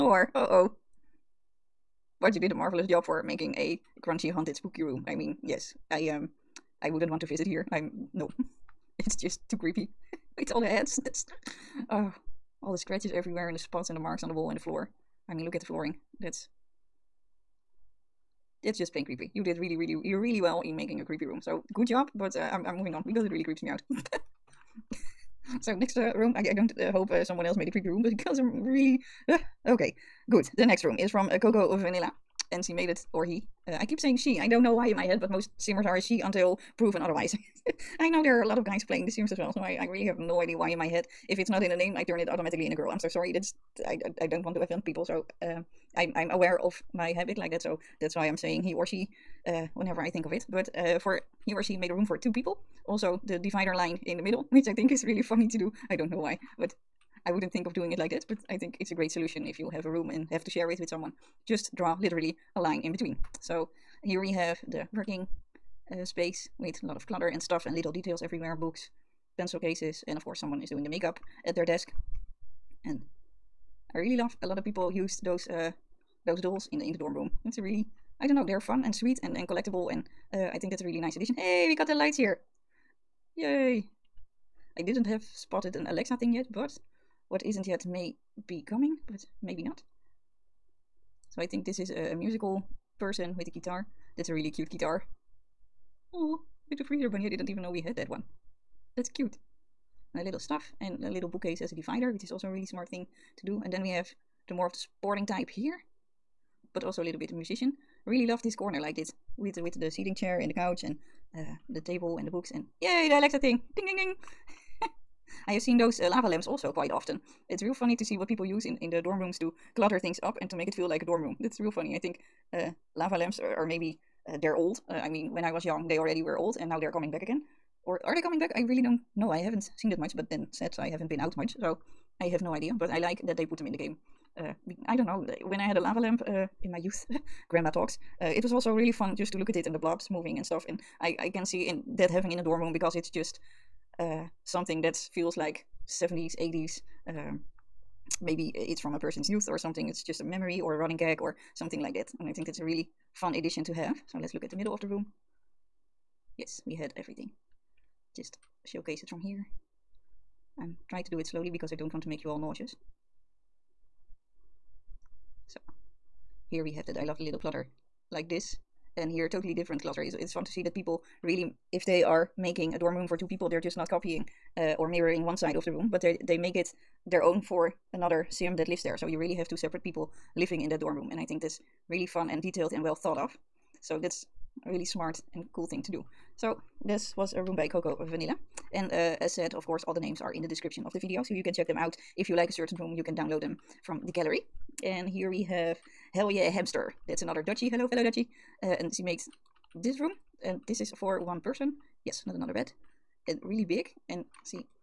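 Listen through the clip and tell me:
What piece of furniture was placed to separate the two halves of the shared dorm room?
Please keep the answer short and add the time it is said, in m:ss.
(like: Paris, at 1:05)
A little bookcase, at 1:41.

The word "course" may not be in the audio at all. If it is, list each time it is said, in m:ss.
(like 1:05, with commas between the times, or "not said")
1:10, 3:09.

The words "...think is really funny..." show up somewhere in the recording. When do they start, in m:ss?
0:54.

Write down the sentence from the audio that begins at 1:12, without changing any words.
And I really love a lot of people use those uh, those dolls in the in the dorm room.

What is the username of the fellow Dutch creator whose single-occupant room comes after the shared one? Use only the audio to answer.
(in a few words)
Hell Yeah Hamster.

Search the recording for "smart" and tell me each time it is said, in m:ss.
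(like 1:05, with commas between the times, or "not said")
1:42, 3:04.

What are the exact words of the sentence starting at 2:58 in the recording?
So you really have two separate people living in that dorm room.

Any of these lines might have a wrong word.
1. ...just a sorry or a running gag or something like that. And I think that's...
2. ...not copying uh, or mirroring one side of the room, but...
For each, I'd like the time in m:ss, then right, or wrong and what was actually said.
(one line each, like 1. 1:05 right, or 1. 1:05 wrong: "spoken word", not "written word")
1. 2:30 wrong: "memory", not "sorry"
2. 2:53 right.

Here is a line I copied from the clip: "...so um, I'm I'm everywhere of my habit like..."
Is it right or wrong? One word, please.
wrong.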